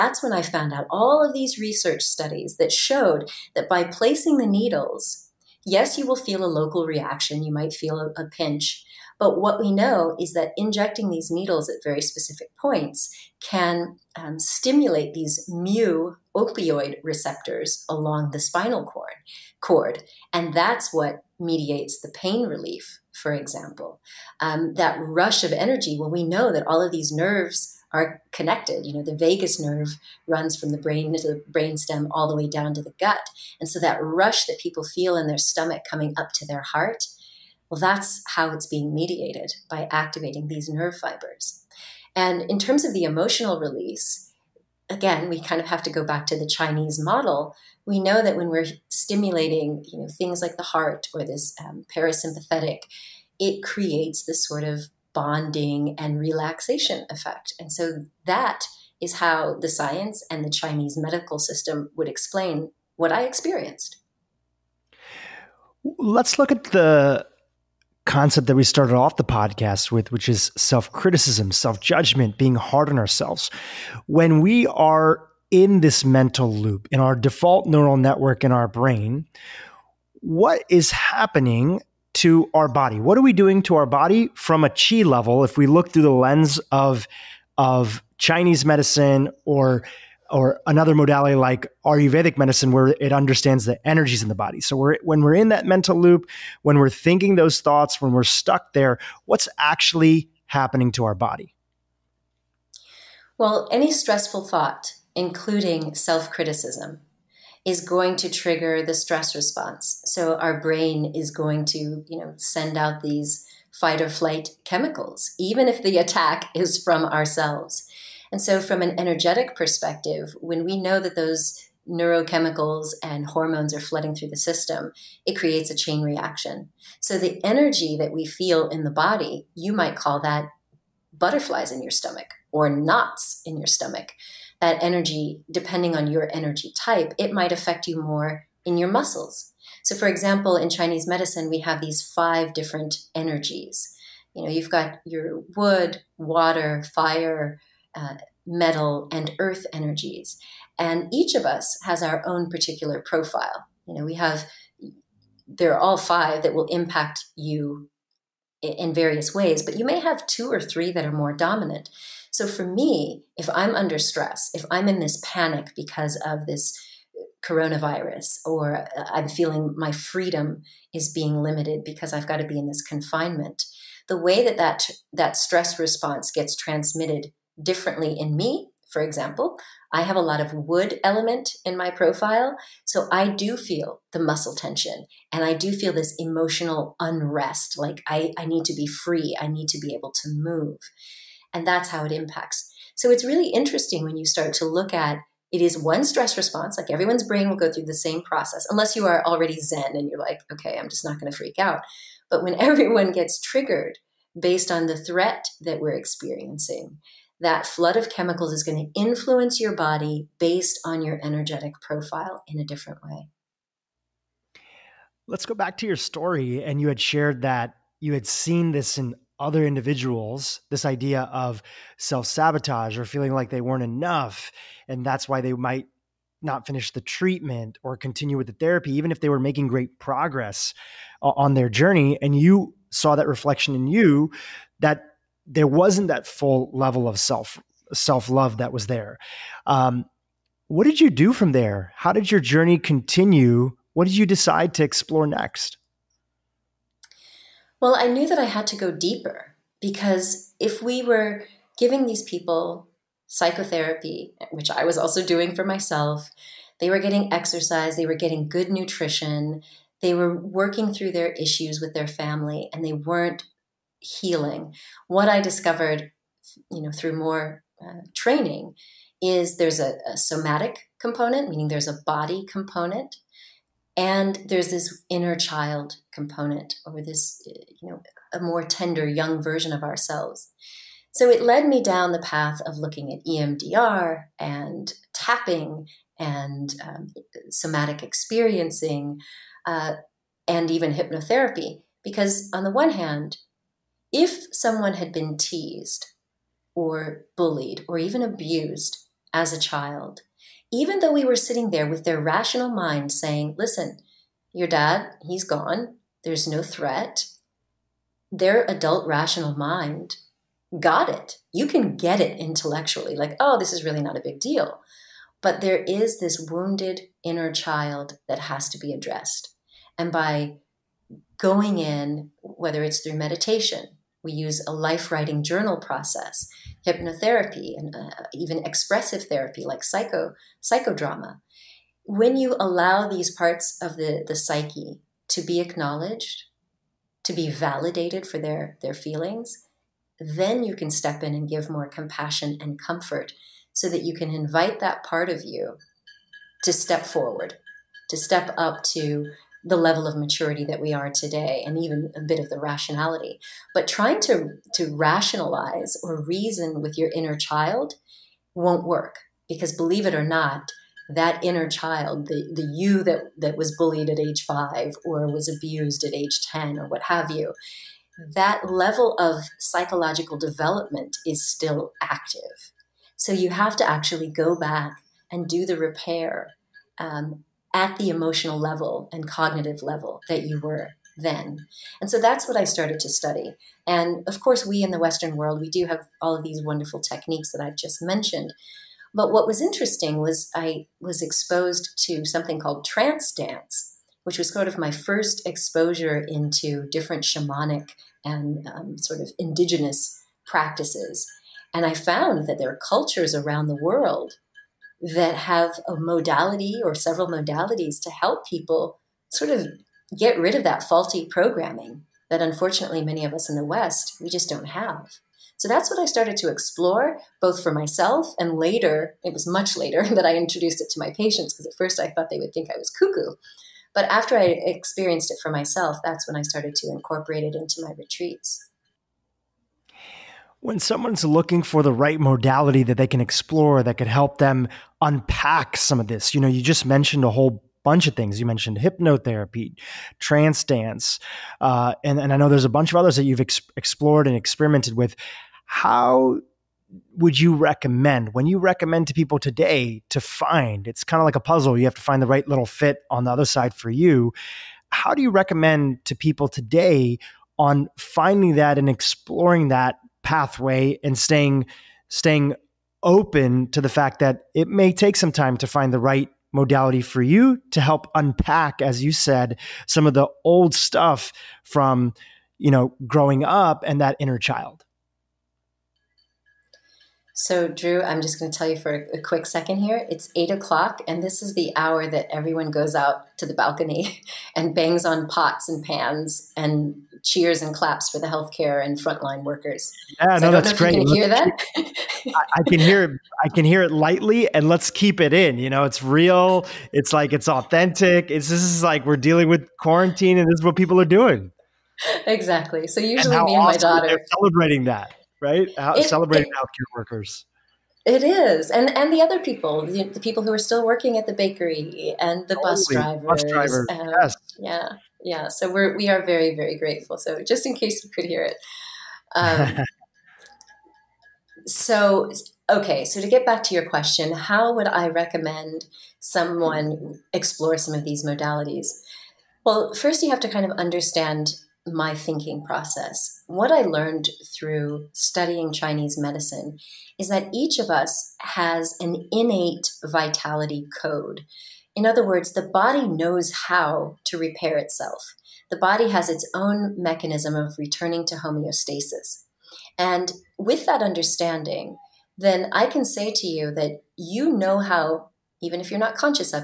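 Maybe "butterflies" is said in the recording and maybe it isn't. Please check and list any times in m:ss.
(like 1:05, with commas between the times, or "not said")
2:11.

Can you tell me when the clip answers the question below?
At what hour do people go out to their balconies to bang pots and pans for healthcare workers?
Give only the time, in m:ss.
8:00.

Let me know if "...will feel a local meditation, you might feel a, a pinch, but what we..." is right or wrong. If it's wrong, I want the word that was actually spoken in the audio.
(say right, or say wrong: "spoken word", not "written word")
wrong: "reaction", not "meditation".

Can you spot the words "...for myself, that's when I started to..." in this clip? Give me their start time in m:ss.
7:05.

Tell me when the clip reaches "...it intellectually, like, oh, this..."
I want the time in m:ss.
5:12.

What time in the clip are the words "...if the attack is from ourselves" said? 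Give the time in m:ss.
1:55.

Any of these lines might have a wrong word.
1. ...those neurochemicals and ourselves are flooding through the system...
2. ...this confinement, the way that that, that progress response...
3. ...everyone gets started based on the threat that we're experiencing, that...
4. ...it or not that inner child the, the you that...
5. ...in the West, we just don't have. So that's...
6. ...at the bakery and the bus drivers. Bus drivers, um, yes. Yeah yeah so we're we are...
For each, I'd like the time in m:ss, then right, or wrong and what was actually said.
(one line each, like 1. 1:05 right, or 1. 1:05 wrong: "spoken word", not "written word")
1. 2:01 wrong: "hormones", not "ourselves"
2. 2:52 wrong: "stress", not "progress"
3. 3:22 wrong: "triggered", not "started"
4. 6:00 right
5. 6:53 right
6. 8:31 right.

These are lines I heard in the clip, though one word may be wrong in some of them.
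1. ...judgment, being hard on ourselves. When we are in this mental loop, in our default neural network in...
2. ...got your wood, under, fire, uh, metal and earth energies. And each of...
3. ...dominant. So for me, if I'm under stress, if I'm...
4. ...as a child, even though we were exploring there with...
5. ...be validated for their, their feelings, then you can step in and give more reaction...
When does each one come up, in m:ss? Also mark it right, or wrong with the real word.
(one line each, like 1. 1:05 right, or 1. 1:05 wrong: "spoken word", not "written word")
1. 1:11 right
2. 2:24 wrong: "water", not "under"
3. 2:41 right
4. 4:59 wrong: "sitting", not "exploring"
5. 5:37 wrong: "compassion", not "reaction".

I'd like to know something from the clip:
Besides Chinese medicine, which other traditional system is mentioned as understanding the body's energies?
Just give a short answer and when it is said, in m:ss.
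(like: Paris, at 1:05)
Ayurvedic medicine, at 1:31.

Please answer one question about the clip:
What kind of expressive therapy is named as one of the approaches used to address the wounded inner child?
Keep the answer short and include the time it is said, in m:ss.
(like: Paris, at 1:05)
psychodrama, at 5:30.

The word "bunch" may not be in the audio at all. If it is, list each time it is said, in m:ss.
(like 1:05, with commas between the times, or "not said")
7:17, 7:22.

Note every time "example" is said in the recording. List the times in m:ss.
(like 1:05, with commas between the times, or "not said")
0:23, 2:20, 2:59.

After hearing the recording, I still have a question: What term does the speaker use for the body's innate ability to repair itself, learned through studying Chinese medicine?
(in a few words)
vitality code.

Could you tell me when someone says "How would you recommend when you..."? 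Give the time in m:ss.
7:25.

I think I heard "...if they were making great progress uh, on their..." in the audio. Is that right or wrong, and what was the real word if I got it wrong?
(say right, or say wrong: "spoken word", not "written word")
right.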